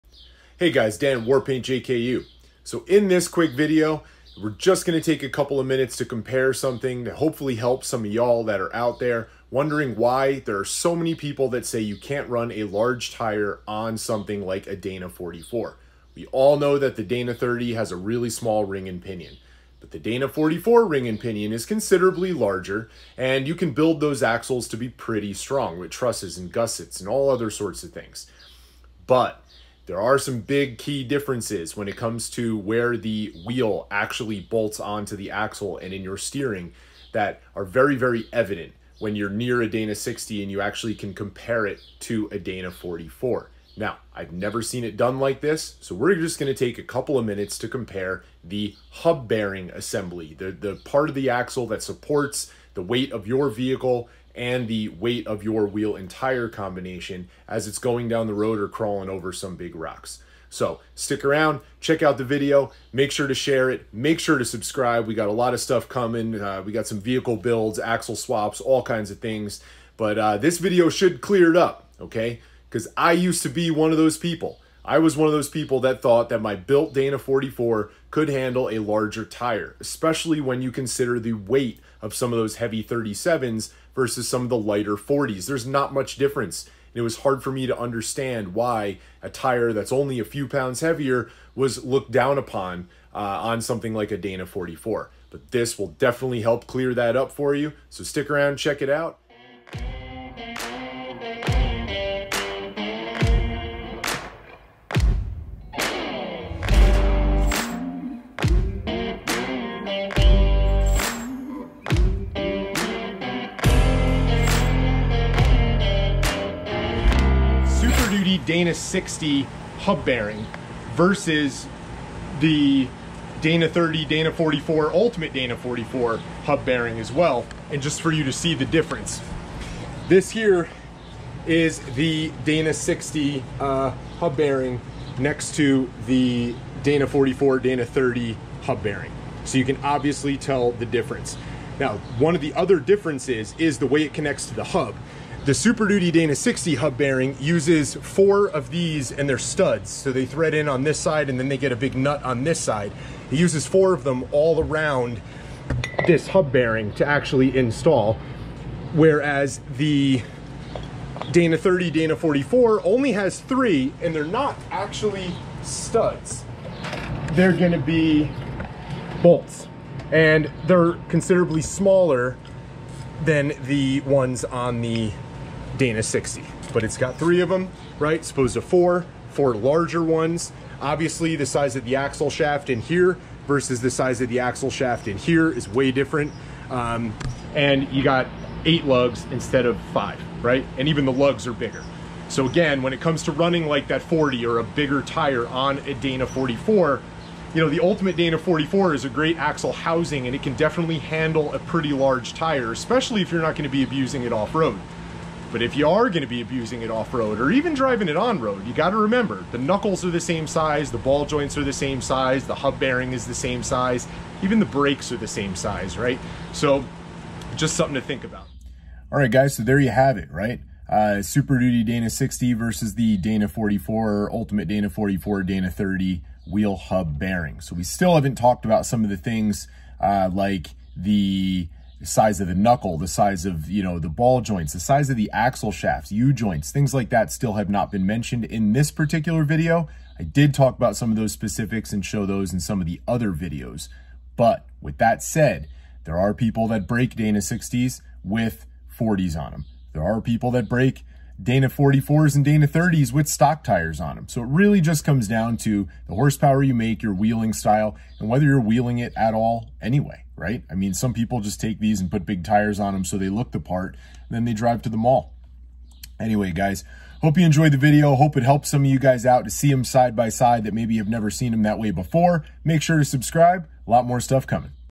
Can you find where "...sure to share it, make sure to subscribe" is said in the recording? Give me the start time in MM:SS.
01:03.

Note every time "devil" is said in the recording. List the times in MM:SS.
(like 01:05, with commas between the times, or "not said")
not said.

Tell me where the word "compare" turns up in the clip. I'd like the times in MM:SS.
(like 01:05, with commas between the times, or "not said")
00:06, 00:41, 00:47.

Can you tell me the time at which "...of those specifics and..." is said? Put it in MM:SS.
04:01.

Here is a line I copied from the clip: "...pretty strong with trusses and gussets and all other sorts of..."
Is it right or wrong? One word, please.
right.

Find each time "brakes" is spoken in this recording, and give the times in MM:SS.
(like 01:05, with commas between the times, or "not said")
03:34.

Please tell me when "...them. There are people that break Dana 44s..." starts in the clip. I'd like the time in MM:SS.
04:09.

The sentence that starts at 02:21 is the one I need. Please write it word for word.
Now, one of the other differences is the way it connects to the hub.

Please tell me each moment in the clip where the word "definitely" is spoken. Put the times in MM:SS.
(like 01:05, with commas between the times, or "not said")
01:35, 03:20.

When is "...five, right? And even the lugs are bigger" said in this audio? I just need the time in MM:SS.
03:09.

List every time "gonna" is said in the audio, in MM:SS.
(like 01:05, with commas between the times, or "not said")
00:04, 00:46, 02:47, 03:23.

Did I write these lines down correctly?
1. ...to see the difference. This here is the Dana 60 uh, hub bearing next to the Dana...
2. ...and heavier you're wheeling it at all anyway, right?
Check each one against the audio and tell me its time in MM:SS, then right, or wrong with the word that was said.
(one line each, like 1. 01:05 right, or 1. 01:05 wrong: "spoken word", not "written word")
1. 02:08 right
2. 04:18 wrong: "whether", not "heavier".